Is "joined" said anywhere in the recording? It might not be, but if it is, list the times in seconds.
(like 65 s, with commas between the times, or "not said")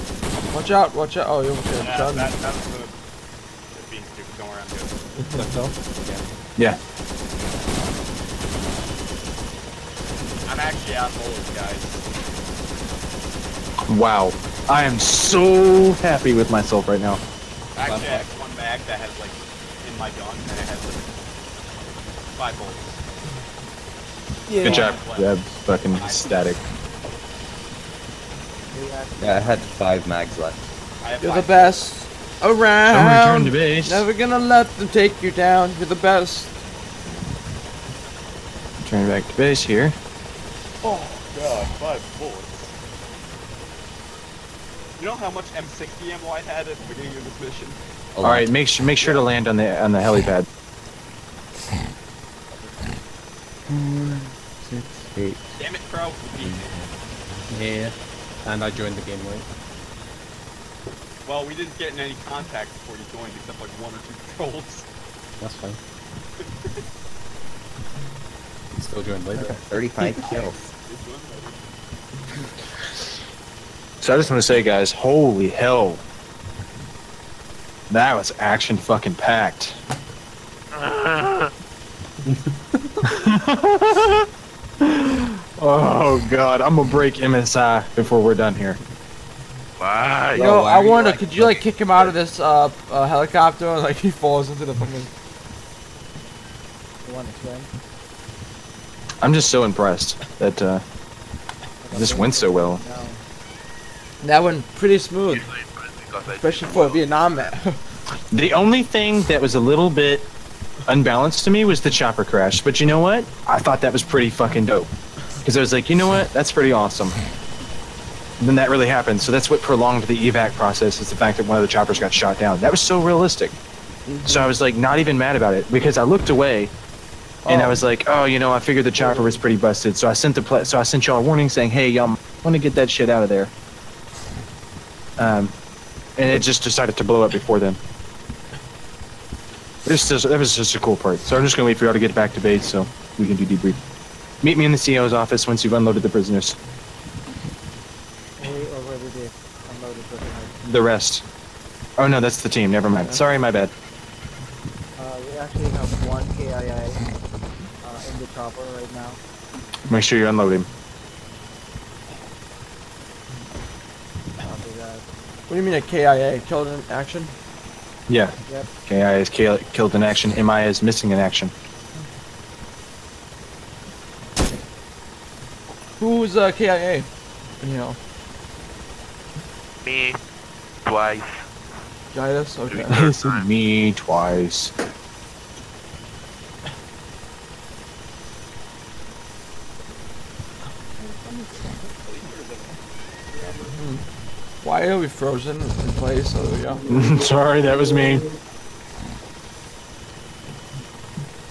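58 s, 63 s, 69 s.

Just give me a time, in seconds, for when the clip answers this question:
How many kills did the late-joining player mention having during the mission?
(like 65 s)
69 s.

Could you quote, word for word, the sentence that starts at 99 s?
I'm just so impressed that uh, this went so well.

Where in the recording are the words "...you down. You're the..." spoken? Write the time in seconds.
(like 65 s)
35 s.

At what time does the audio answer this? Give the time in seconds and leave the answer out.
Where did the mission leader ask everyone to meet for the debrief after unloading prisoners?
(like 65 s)
144 s.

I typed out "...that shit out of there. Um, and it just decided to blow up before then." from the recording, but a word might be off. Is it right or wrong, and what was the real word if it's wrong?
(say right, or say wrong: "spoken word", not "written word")
right.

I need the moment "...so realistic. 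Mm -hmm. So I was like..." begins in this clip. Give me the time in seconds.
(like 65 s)
122 s.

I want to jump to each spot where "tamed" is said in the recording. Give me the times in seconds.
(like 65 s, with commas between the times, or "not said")
not said.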